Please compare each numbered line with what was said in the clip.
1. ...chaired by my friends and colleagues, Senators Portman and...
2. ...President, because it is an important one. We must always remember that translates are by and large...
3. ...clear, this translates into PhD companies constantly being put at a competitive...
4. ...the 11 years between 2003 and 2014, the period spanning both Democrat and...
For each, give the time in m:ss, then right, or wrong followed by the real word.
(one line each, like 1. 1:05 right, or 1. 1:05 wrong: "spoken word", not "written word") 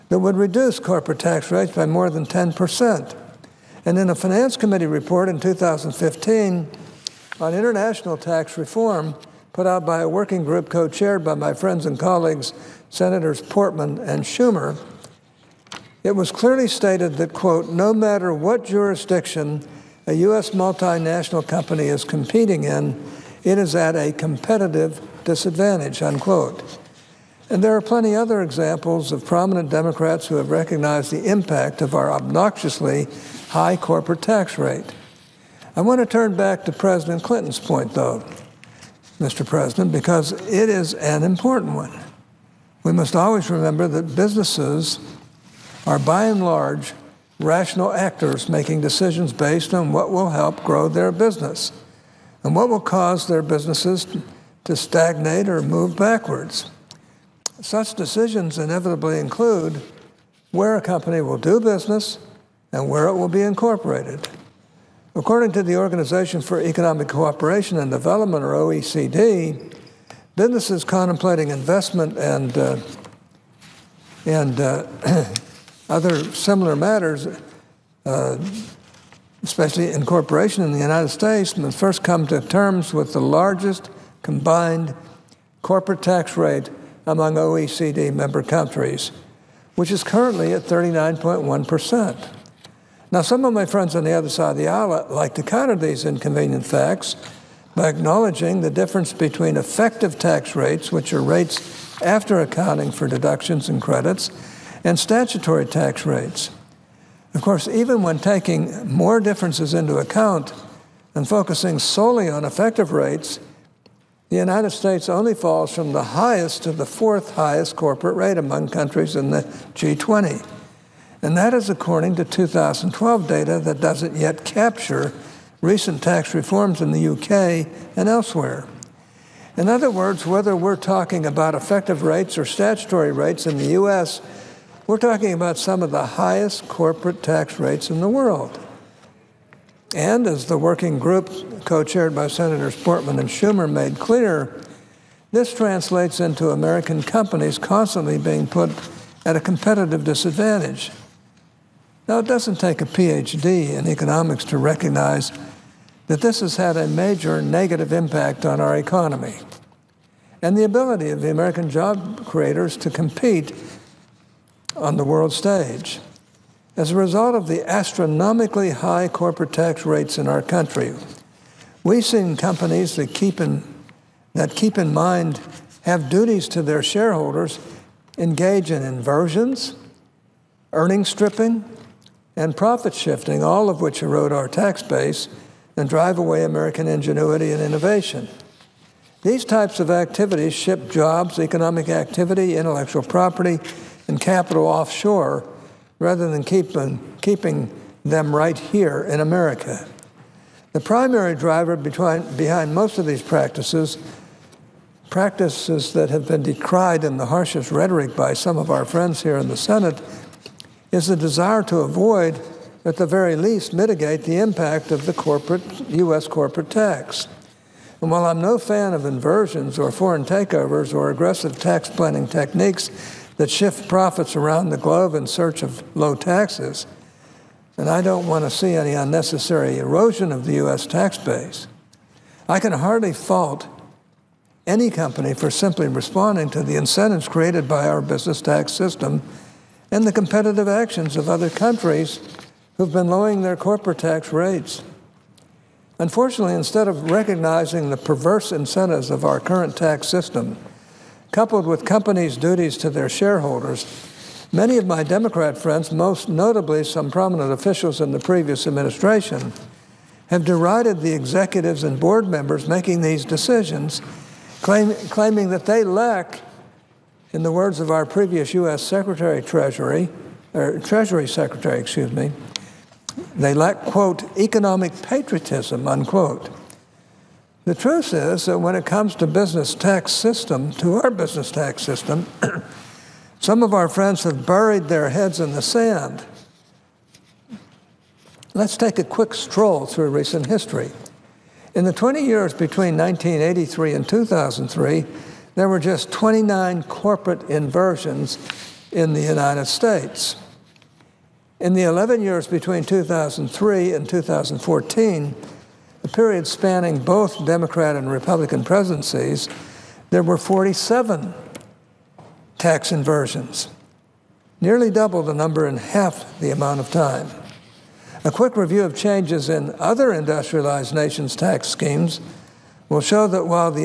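1. 0:10 right
2. 0:39 wrong: "businesses", not "translates"
3. 2:23 wrong: "American", not "PhD"
4. 5:01 right.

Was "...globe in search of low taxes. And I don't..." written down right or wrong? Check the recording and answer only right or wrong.
right.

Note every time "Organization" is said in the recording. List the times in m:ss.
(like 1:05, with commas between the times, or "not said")
1:05.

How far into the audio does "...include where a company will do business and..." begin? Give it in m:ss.
0:59.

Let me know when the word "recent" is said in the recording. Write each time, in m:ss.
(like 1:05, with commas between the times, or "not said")
2:05, 4:50.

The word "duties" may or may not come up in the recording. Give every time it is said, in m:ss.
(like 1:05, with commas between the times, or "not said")
2:56, 4:12.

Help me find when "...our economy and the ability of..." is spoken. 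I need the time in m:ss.
2:38.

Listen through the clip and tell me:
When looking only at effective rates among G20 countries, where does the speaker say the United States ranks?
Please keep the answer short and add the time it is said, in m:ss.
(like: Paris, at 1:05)
fourth highest, at 1:56.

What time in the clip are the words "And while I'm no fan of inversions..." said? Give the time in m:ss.
3:38.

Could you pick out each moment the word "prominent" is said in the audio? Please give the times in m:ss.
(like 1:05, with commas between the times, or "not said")
0:29, 4:17.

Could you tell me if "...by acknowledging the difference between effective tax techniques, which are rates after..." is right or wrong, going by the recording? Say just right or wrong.
wrong.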